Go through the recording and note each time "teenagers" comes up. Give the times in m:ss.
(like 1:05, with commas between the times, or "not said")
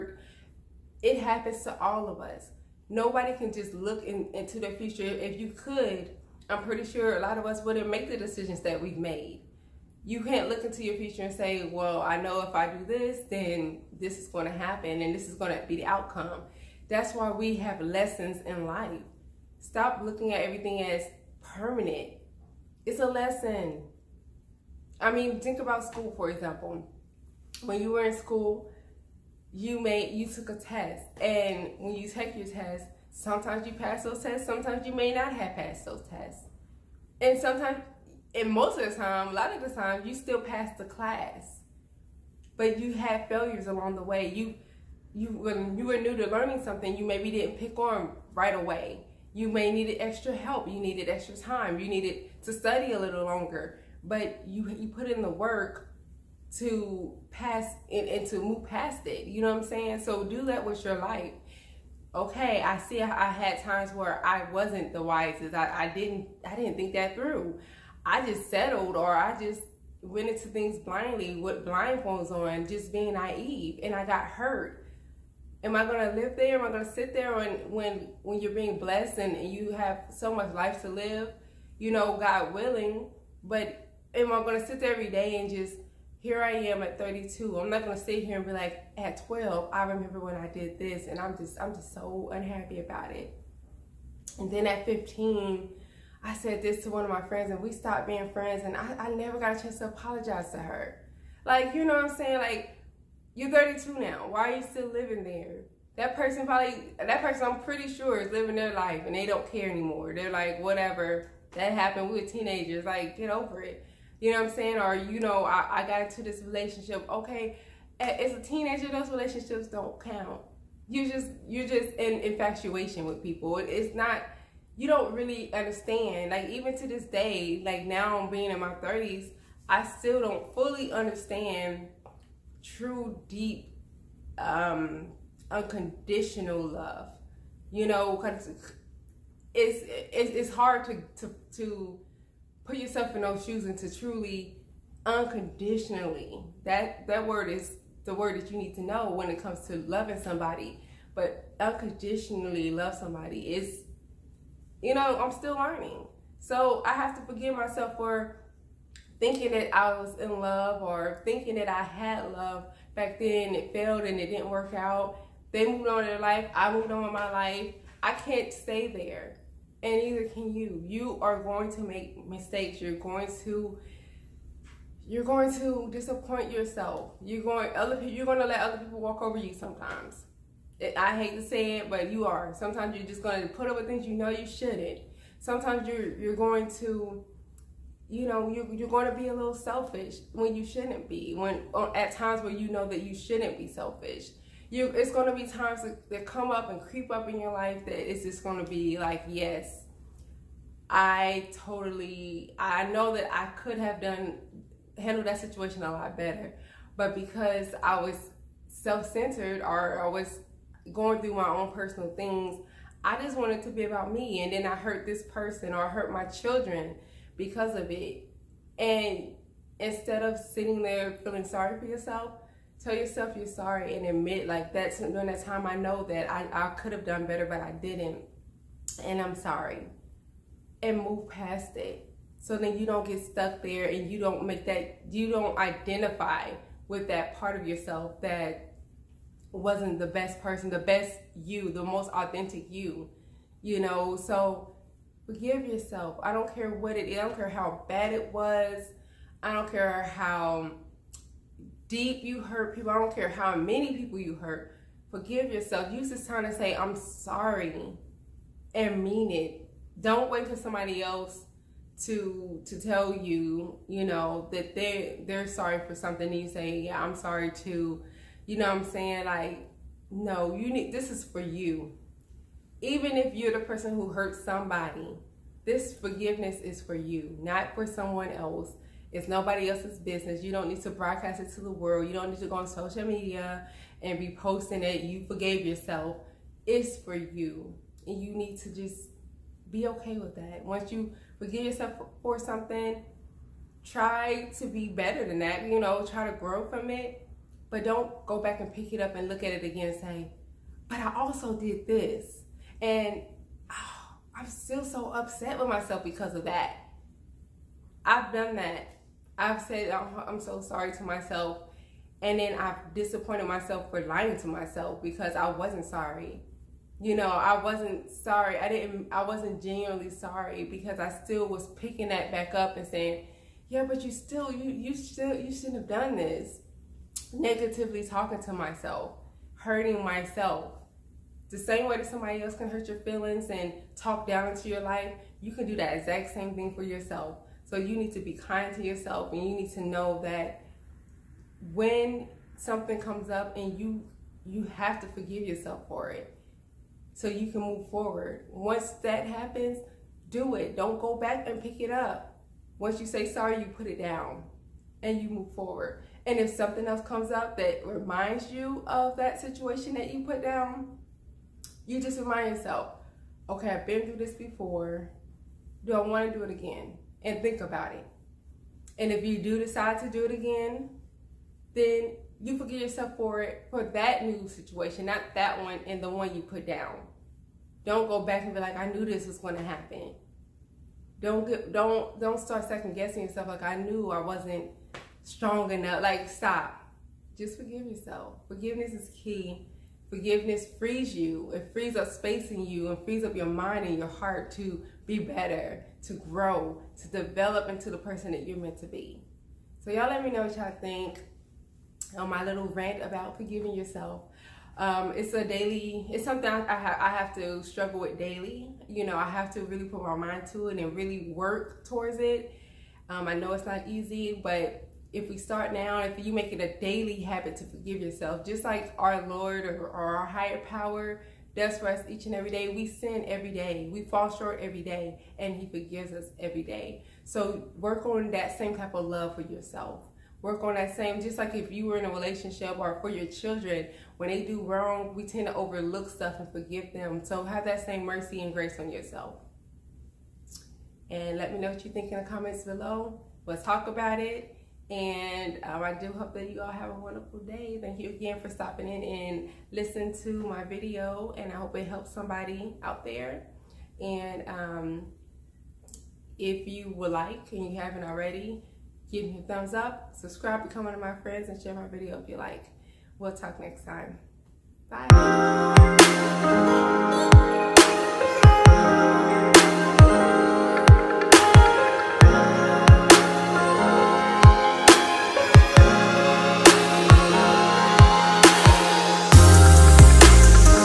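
1:52, 1:58.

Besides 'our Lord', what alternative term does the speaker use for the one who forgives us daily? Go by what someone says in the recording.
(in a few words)
higher power.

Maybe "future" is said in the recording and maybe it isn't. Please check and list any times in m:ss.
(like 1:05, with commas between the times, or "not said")
0:04, 0:10.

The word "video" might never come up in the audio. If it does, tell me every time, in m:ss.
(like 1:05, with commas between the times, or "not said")
7:30, 7:41.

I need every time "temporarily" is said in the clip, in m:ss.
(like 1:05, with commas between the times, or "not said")
not said.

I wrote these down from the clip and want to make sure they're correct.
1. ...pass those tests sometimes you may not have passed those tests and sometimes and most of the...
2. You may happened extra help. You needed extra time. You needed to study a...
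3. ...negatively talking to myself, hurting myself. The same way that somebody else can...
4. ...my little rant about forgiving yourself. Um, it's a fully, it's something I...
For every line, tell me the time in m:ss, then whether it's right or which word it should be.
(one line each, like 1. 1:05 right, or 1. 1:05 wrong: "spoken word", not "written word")
1. 0:33 right
2. 0:49 wrong: "needed", not "happened"
3. 5:27 right
4. 6:42 wrong: "daily", not "fully".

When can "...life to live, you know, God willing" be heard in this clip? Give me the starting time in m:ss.
1:20.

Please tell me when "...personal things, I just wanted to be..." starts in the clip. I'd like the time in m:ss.
3:31.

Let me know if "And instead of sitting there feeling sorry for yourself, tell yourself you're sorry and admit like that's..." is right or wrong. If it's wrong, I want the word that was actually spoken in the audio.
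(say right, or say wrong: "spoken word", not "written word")
right.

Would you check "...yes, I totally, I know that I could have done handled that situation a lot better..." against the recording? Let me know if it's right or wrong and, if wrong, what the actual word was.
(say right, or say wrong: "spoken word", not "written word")
right.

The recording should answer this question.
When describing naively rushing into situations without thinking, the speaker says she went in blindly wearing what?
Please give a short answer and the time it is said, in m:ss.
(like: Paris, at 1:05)
blindfolds, at 1:11.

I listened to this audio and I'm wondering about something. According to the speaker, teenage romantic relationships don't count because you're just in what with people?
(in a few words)
infatuation.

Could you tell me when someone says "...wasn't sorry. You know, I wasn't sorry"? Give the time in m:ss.
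5:15.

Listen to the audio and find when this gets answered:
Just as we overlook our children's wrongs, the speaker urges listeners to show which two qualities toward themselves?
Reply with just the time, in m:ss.
7:18.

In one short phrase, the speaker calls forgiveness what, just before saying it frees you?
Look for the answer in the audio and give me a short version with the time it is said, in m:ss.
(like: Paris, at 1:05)
key, at 6:29.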